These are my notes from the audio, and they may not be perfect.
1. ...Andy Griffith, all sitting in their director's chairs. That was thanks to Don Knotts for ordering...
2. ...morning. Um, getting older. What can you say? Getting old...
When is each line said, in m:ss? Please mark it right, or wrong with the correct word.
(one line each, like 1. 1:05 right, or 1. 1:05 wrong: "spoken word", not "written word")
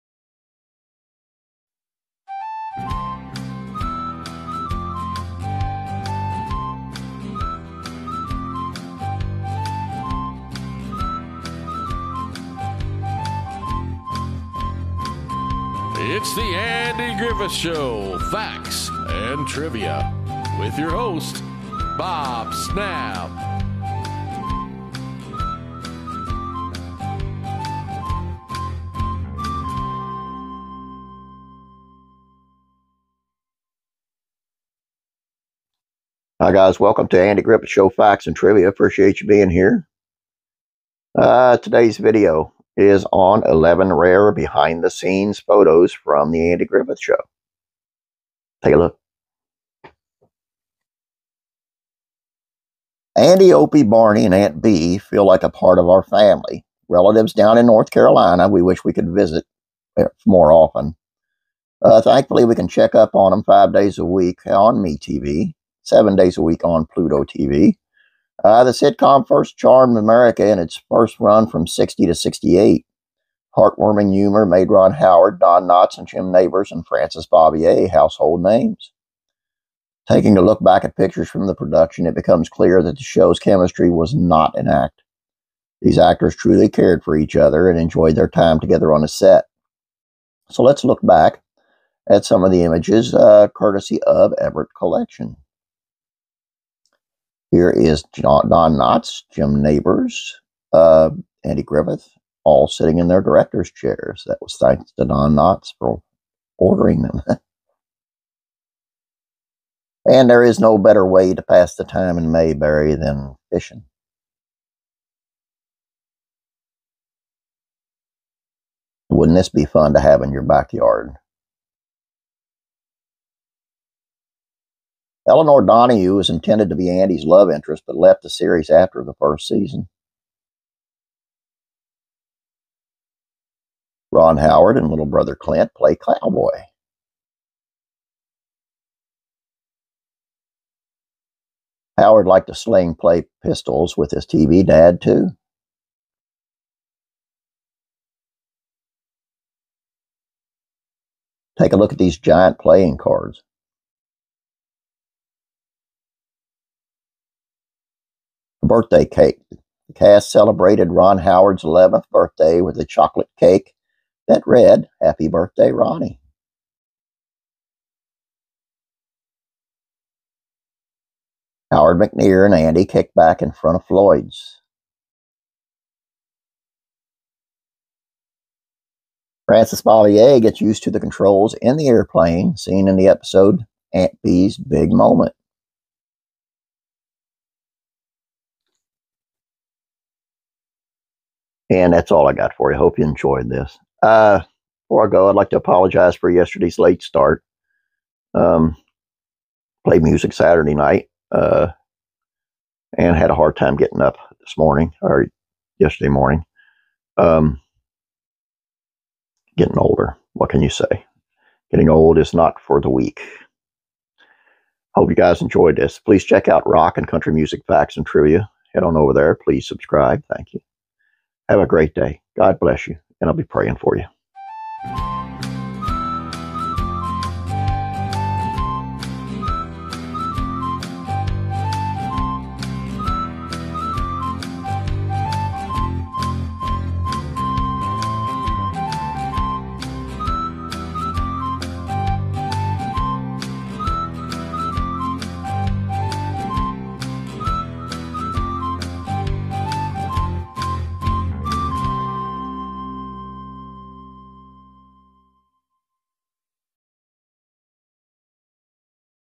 1. 1:41 right
2. 3:26 right.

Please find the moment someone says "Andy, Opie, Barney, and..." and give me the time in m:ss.
0:53.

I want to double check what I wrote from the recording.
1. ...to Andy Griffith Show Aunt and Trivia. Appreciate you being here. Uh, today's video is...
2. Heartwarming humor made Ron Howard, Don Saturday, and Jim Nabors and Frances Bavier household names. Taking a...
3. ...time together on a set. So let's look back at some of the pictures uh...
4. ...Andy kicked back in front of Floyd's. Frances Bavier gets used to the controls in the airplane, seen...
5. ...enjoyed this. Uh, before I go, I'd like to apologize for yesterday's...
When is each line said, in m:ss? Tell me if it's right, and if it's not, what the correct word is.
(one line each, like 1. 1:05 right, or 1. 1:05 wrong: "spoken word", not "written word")
1. 0:37 wrong: "Facts", not "Aunt"
2. 1:13 wrong: "Knotts", not "Saturday"
3. 1:28 wrong: "images", not "pictures"
4. 2:52 right
5. 3:13 right.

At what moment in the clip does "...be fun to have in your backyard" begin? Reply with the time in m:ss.
1:59.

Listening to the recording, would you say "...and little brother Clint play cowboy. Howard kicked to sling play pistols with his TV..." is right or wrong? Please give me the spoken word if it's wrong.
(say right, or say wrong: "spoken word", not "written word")
wrong: "liked", not "kicked".